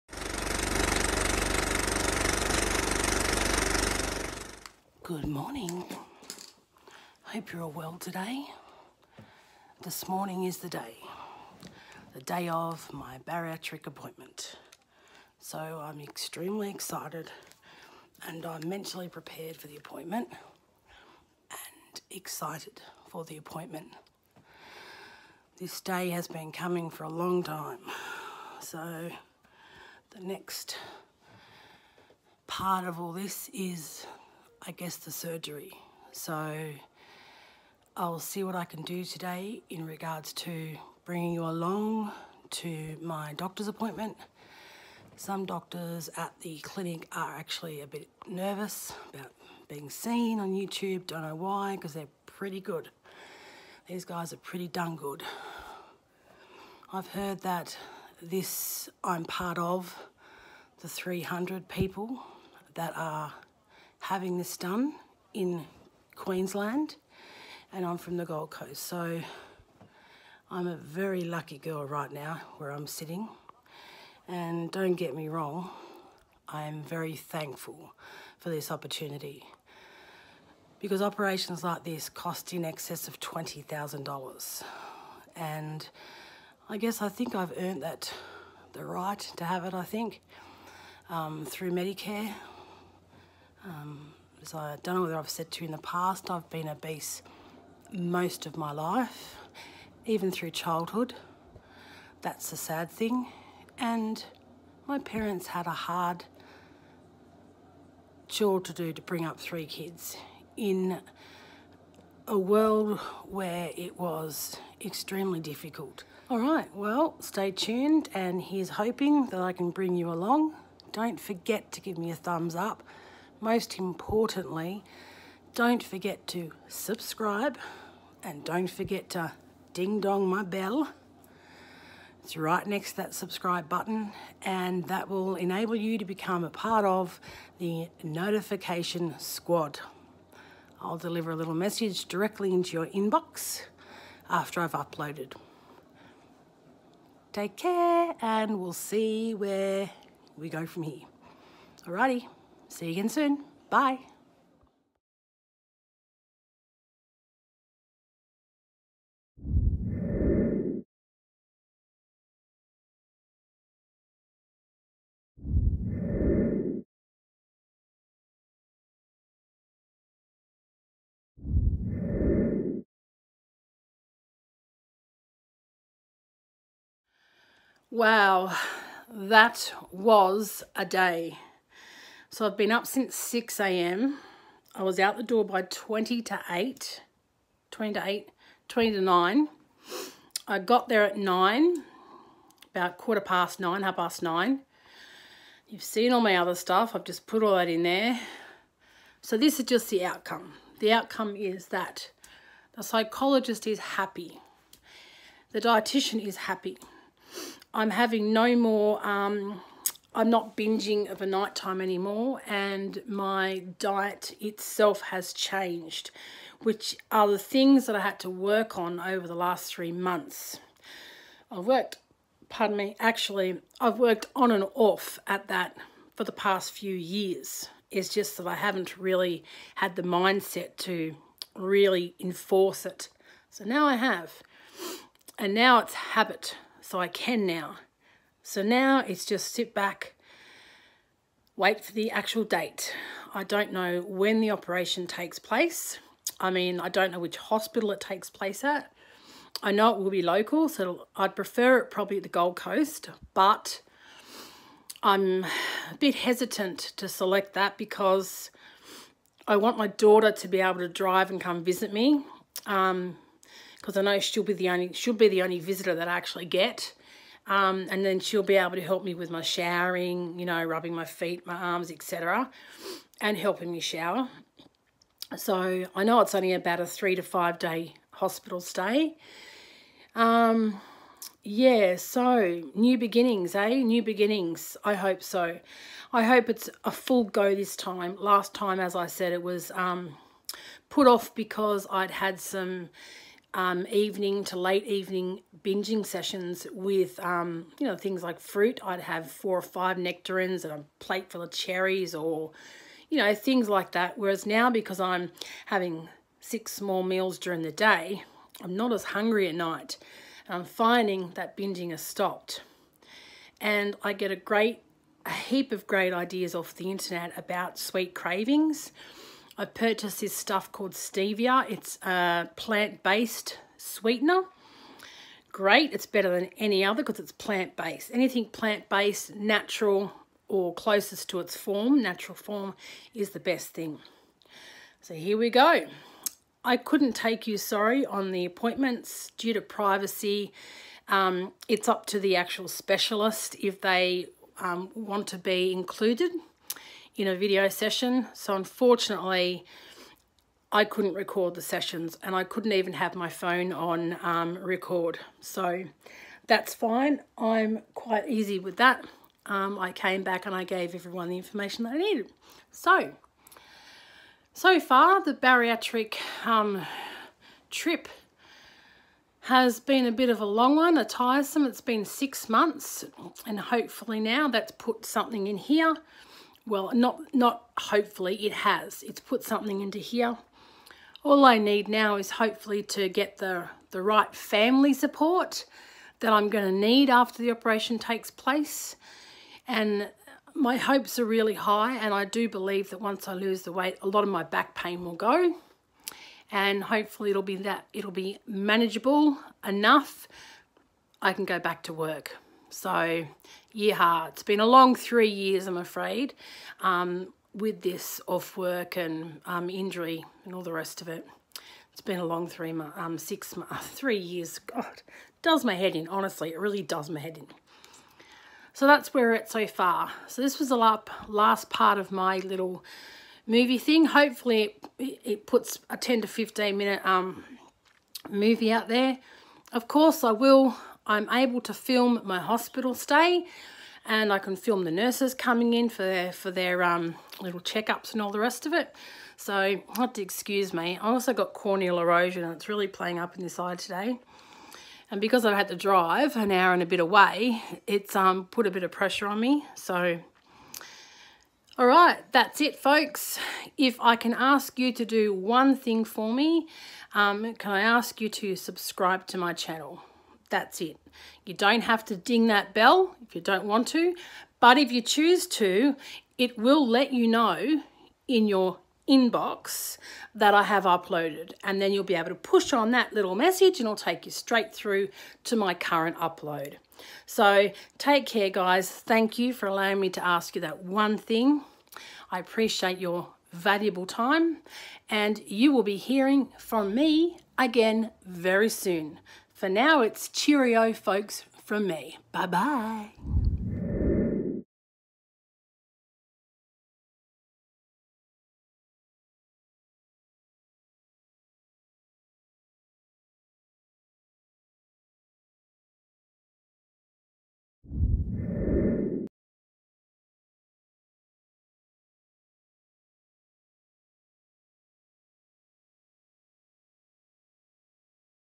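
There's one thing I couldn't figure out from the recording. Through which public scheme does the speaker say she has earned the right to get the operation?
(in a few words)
Medicare.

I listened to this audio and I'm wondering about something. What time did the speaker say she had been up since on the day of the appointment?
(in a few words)
6 a.m.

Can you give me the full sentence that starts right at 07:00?
So this was the last part of my little movie thing.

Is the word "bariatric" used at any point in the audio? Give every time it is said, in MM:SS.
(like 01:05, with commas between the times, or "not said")
00:13, 06:05.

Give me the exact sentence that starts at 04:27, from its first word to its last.
Um, and then she'll be able to help me with my showering, you know, rubbing my feet, my arms, etc.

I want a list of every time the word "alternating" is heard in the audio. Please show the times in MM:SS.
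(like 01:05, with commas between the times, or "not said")
not said.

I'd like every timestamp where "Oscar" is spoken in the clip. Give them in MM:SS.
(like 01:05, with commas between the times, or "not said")
not said.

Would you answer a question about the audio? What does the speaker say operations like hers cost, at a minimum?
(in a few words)
$20,000.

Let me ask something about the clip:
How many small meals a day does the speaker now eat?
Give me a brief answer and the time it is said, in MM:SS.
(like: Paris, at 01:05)
6, at 05:06.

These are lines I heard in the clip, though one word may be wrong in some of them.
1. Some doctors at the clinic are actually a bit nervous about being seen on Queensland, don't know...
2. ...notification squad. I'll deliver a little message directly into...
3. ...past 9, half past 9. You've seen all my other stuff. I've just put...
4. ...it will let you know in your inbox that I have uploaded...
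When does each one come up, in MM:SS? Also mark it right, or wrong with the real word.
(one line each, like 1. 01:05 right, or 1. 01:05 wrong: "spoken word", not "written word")
1. 00:45 wrong: "YouTube", not "Queensland"
2. 02:18 right
3. 03:13 right
4. 07:46 right.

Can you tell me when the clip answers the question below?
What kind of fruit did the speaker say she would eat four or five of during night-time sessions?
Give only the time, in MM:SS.
04:59.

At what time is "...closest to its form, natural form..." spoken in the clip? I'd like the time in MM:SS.
05:30.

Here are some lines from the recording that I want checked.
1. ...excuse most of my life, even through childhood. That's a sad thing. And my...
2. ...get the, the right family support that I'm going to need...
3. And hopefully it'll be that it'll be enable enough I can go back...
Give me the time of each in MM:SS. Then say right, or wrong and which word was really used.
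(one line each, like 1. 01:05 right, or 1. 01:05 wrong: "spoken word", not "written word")
1. 01:36 wrong: "obese", not "excuse"
2. 06:23 right
3. 06:36 wrong: "manageable", not "enable".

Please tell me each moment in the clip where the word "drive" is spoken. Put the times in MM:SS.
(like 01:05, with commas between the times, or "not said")
04:20, 07:25.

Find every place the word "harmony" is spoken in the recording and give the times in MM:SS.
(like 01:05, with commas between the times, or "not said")
not said.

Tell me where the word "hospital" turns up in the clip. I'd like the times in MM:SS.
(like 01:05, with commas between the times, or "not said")
04:07, 04:38, 07:12.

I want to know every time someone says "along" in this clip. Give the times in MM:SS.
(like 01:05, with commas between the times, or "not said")
00:41, 02:00.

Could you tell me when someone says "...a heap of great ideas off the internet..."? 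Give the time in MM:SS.
05:15.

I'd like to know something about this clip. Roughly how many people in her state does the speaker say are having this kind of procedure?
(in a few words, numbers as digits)
300.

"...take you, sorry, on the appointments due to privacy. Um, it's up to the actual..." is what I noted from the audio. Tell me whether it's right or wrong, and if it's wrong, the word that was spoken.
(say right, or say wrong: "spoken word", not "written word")
right.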